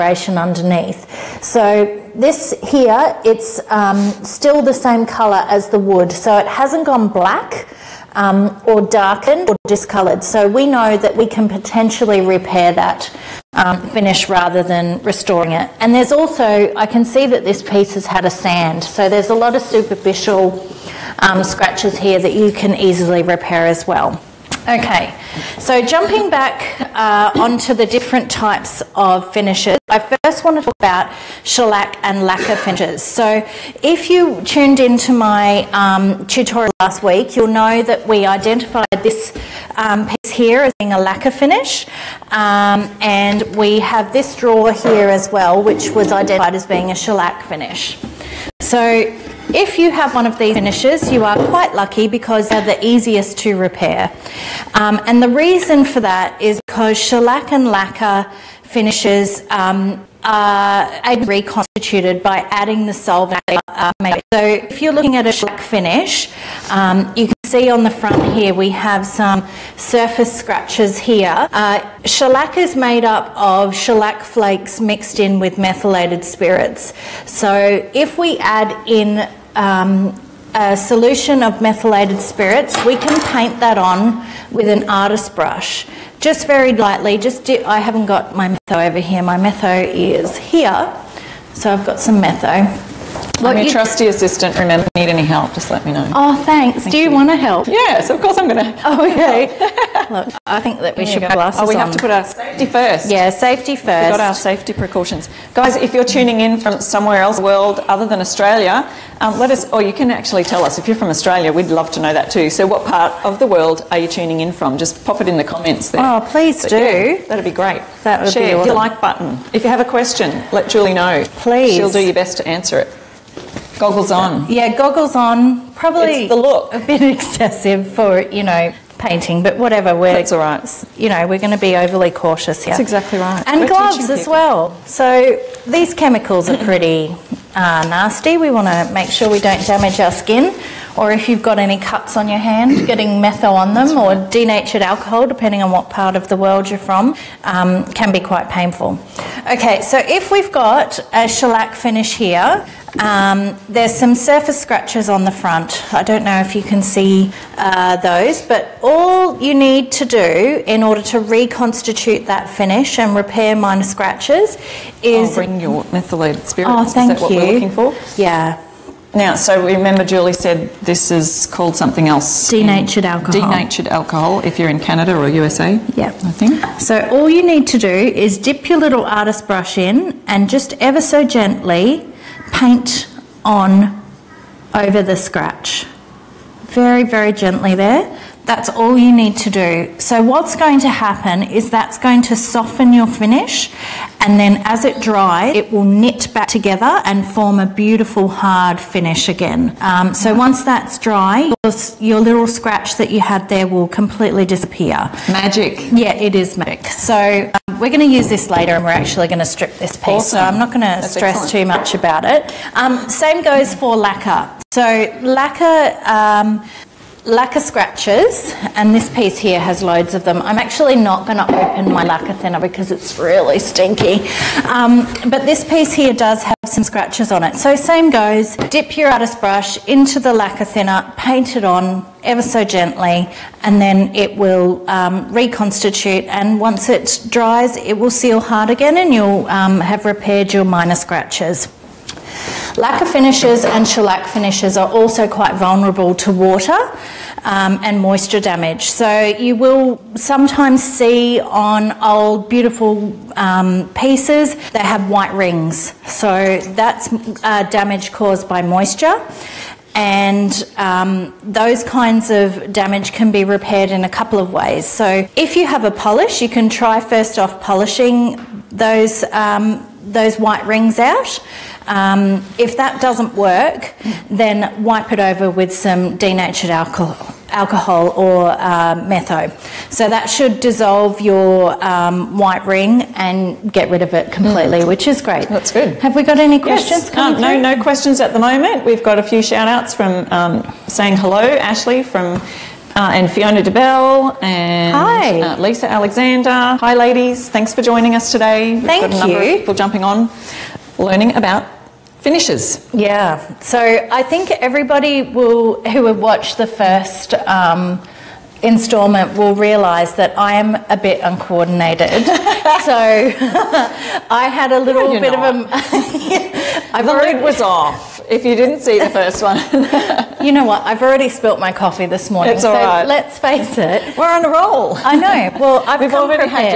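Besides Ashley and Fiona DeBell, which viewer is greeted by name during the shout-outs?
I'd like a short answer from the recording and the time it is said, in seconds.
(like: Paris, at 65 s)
Lisa Alexander, at 295 s.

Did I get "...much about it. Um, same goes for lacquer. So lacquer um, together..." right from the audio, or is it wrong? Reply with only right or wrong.
wrong.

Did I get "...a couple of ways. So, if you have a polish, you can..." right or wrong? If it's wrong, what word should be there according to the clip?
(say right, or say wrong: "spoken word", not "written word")
right.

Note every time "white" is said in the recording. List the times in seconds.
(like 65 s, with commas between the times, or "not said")
255 s, 270 s, 282 s.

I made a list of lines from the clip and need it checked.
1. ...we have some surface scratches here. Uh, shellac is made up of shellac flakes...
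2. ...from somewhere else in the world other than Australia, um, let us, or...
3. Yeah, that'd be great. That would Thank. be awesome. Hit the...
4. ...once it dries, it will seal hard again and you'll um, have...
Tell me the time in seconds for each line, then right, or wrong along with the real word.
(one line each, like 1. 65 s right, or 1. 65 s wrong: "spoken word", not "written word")
1. 68 s right
2. 106 s right
3. 116 s wrong: "Share", not "Thank"
4. 236 s right.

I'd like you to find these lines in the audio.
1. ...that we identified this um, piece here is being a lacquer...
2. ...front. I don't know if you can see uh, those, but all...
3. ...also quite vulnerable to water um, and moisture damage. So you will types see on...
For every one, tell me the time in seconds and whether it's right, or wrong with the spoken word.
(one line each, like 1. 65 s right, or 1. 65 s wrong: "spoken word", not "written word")
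1. 37 s right
2. 155 s right
3. 244 s wrong: "sometimes", not "types".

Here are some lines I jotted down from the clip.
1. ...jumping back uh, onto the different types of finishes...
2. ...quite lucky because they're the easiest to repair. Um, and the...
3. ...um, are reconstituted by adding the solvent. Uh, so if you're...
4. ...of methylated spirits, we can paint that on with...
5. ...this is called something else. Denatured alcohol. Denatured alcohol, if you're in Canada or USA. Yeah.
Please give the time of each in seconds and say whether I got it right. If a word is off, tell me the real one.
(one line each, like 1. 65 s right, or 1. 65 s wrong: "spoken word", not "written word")
1. 25 s right
2. 51 s right
3. 59 s right
4. 81 s right
5. 170 s right.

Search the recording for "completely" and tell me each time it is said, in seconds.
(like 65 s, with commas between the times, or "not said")
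203 s, 284 s.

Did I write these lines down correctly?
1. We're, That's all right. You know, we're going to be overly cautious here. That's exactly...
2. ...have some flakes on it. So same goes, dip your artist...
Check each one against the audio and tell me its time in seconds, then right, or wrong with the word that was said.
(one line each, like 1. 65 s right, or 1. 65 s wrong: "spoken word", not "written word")
1. 129 s right
2. 226 s wrong: "scratches", not "flakes".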